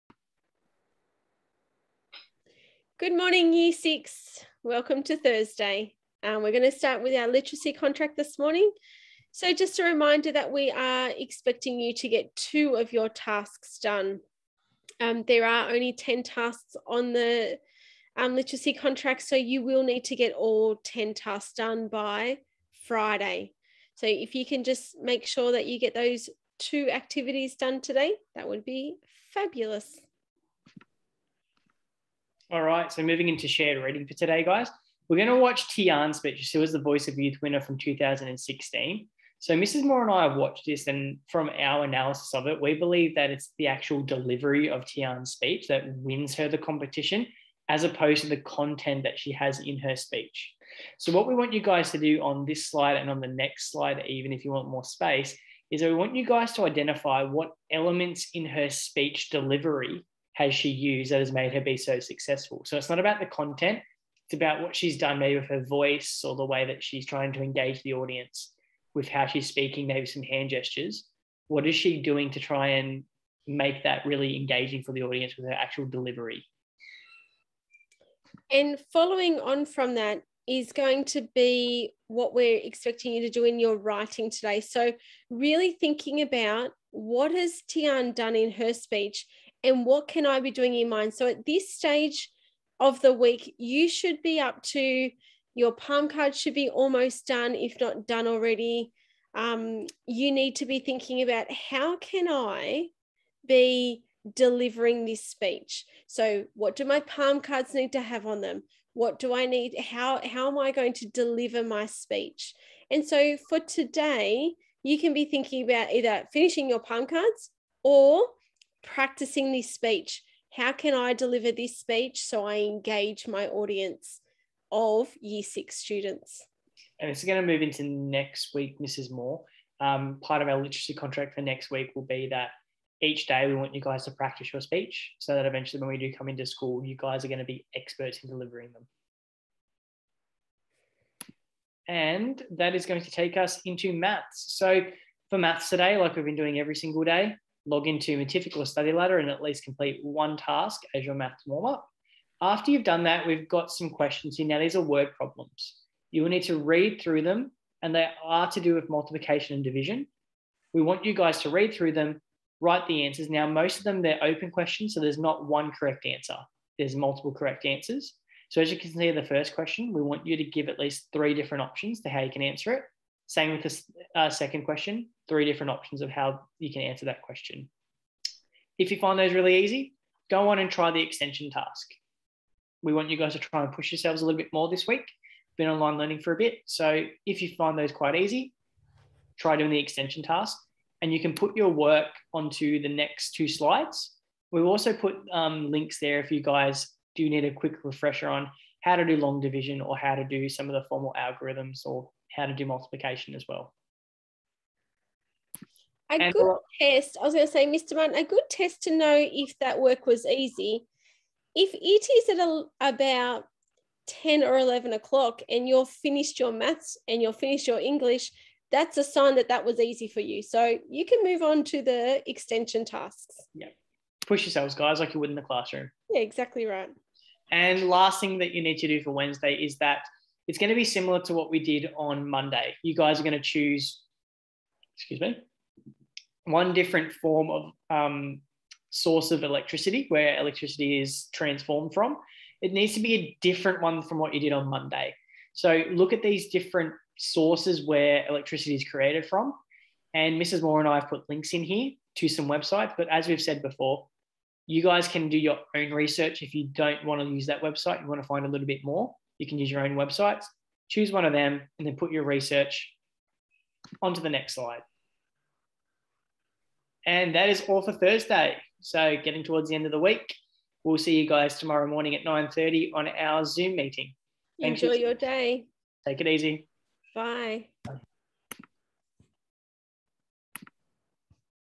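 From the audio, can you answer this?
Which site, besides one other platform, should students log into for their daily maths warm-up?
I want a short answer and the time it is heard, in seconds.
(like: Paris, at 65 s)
Study Ladder, at 148 s.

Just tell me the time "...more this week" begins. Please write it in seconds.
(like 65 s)
184 s.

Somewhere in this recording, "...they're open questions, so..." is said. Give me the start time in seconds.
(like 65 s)
164 s.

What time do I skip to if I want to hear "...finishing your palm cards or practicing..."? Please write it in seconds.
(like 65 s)
116 s.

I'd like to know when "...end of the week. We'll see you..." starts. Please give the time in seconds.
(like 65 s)
269 s.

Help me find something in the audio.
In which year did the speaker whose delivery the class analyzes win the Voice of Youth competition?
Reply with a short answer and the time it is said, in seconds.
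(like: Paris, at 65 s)
2016, at 37 s.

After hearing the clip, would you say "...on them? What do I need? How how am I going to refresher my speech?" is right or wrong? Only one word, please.
wrong.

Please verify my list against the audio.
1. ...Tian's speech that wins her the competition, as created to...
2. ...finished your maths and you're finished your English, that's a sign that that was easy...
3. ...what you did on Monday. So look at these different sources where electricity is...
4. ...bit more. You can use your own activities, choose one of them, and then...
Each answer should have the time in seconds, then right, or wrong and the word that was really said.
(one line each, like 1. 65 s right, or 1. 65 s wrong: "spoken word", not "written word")
1. 44 s wrong: "opposed", not "created"
2. 215 s right
3. 244 s right
4. 258 s wrong: "websites", not "activities".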